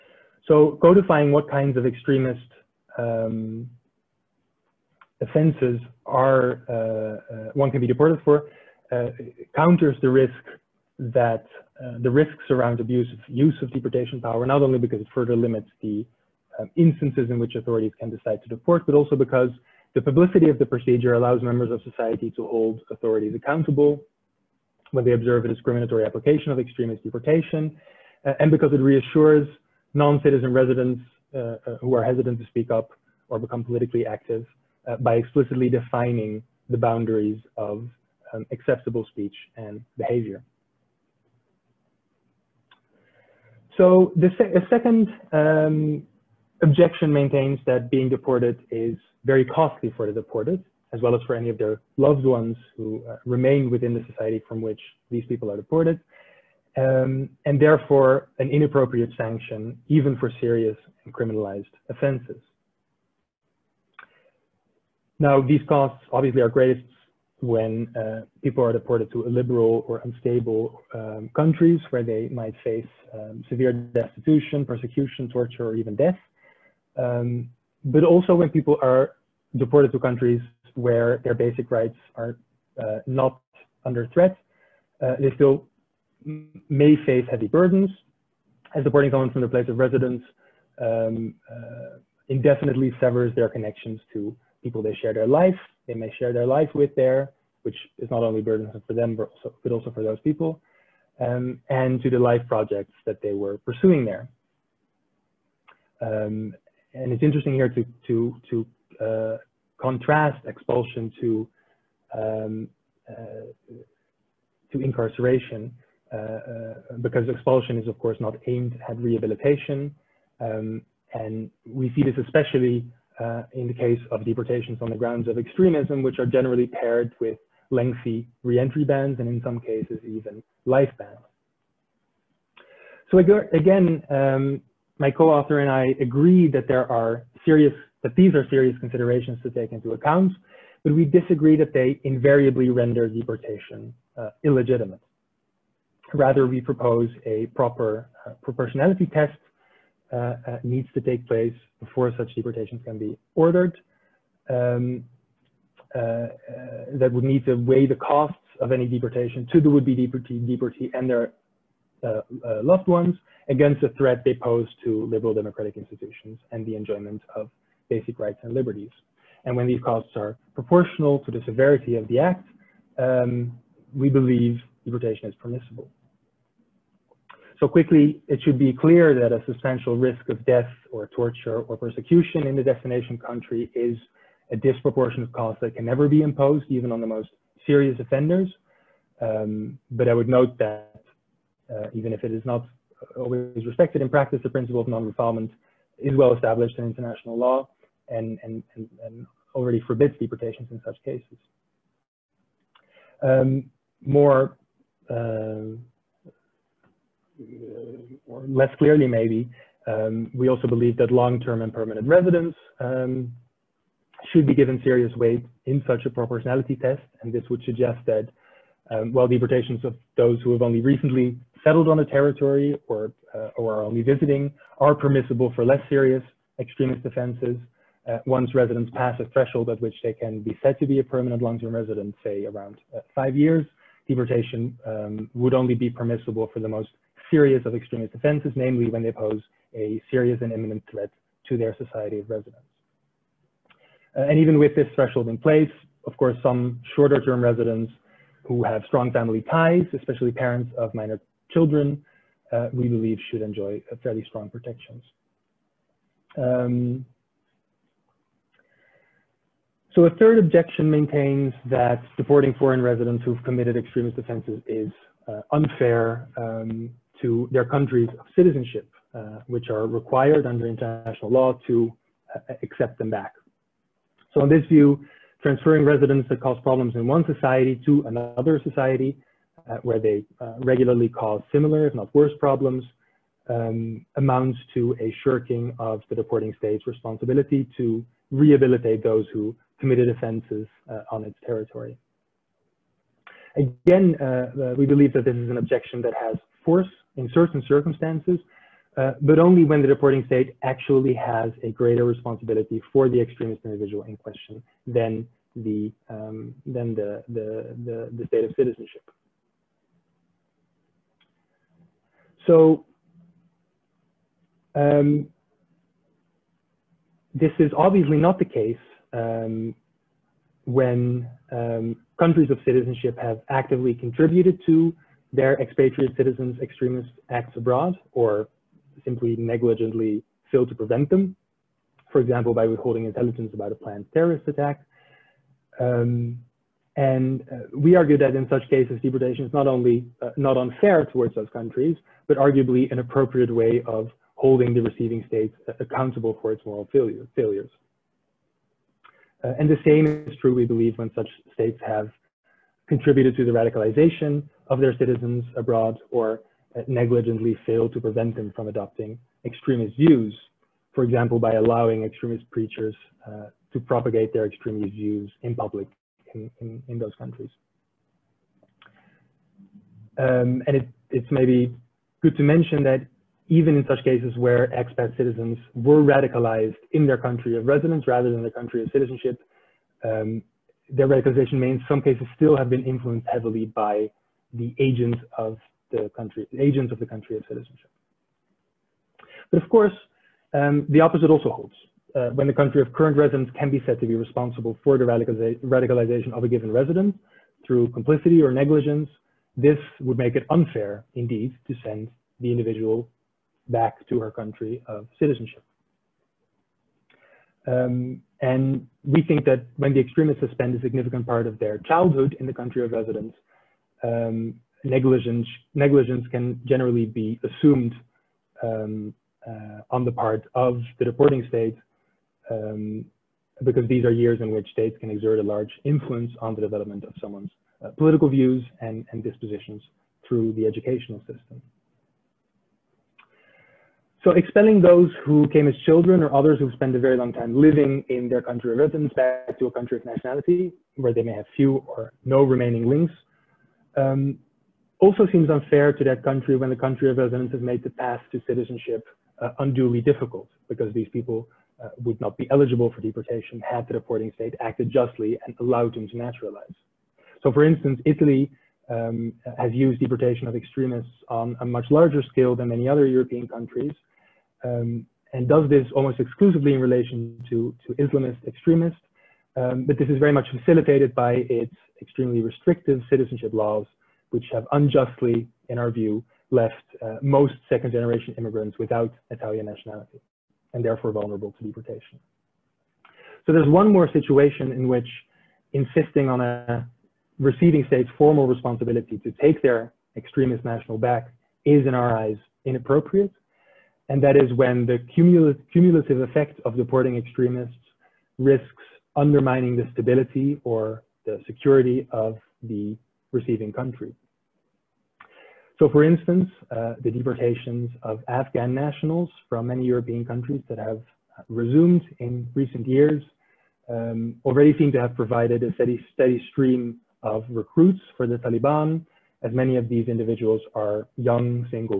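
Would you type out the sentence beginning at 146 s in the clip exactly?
Rather, we propose a proper uh, proportionality test uh, uh needs to take place before such deportations can be ordered.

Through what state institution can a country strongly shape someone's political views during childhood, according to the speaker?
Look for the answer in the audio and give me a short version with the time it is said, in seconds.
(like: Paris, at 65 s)
educational system, at 430 s.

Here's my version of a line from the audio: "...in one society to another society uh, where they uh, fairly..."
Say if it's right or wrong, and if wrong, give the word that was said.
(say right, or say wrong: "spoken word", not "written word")
wrong: "regularly", not "fairly".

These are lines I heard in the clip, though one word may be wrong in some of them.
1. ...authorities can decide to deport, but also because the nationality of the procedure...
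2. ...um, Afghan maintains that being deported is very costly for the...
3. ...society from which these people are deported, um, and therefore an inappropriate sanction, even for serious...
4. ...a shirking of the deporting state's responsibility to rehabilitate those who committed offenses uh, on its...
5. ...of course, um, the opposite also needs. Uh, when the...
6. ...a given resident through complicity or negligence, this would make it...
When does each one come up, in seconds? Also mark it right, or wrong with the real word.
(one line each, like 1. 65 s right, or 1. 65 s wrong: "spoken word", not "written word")
1. 17 s wrong: "publicity", not "nationality"
2. 45 s wrong: "Objection", not "Afghan"
3. 54 s right
4. 284 s right
5. 389 s wrong: "holds", not "needs"
6. 396 s right.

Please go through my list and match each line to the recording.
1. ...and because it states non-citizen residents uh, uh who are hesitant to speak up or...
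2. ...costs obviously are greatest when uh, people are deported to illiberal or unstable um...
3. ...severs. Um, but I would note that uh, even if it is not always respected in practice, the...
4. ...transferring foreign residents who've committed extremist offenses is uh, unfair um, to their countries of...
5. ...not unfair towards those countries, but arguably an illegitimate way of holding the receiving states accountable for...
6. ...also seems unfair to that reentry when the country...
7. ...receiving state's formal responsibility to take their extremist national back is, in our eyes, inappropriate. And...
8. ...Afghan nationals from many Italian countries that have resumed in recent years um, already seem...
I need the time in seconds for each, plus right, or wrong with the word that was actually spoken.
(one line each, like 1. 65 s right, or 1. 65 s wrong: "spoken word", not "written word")
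1. 28 s wrong: "reassures", not "states"
2. 65 s right
3. 187 s wrong: "offenders", not "severs"
4. 262 s wrong: "deporting", not "transferring"
5. 340 s wrong: "appropriate", not "illegitimate"
6. 445 s wrong: "country", not "reentry"
7. 487 s right
8. 508 s wrong: "European", not "Italian".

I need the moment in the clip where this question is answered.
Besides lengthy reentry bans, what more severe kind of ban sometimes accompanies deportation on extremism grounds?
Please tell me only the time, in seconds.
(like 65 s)
130 s.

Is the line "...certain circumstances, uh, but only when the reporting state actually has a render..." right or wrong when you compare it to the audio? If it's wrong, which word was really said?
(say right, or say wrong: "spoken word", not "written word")
wrong: "greater", not "render".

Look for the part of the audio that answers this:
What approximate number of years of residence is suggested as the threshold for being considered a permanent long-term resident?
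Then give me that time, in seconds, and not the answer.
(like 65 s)
233 s.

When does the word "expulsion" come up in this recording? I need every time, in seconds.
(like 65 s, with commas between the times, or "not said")
110 s, 117 s.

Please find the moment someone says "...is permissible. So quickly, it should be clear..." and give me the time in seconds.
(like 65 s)
175 s.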